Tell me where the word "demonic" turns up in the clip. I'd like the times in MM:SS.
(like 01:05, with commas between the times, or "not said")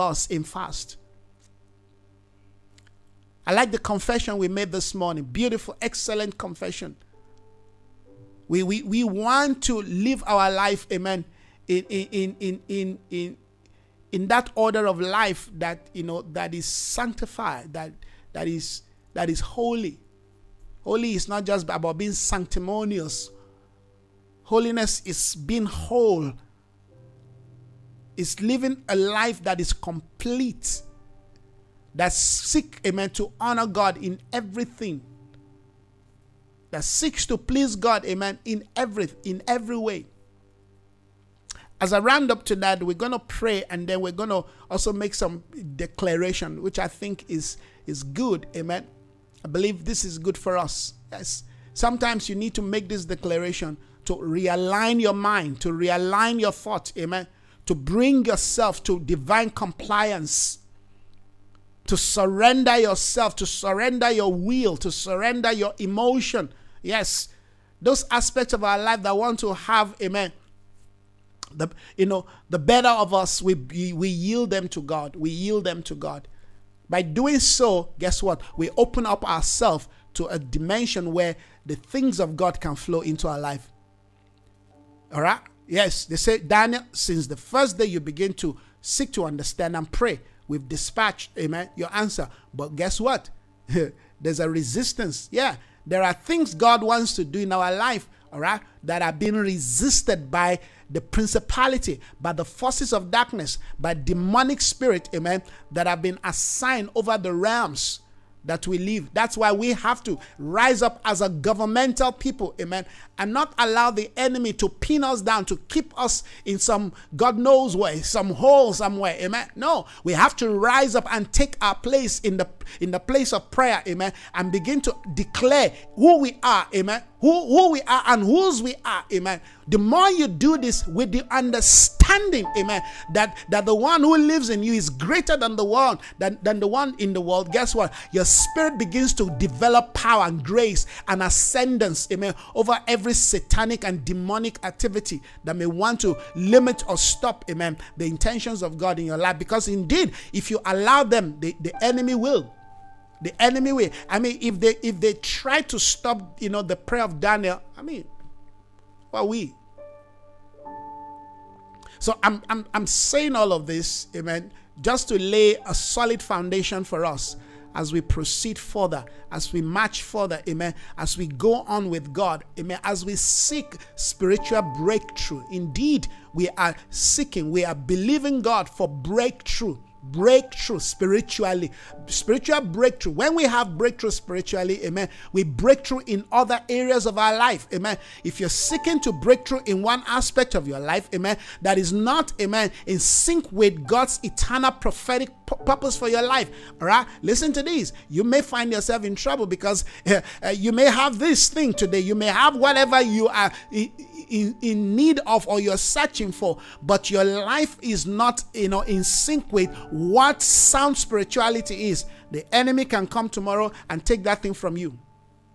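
01:43, 02:24.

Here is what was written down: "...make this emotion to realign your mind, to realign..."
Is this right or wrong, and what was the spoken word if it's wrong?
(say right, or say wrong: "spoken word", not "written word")
wrong: "declaration", not "emotion".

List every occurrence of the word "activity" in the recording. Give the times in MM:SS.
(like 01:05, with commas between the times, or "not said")
02:24.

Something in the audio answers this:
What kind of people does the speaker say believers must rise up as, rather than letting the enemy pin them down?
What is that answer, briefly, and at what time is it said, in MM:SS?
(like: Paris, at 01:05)
Governmental people, at 01:51.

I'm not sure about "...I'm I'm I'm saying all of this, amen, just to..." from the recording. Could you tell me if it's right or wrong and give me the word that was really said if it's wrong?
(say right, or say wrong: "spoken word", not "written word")
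right.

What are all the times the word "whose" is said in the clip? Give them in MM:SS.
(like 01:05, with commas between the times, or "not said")
02:08.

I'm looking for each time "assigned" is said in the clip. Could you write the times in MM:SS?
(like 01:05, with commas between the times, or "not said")
01:46.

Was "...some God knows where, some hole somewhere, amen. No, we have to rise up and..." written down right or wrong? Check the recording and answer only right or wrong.
right.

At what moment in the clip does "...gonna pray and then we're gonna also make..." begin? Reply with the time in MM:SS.
00:42.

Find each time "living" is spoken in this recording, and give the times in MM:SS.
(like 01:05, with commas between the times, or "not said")
00:28.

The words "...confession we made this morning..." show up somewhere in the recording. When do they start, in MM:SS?
00:03.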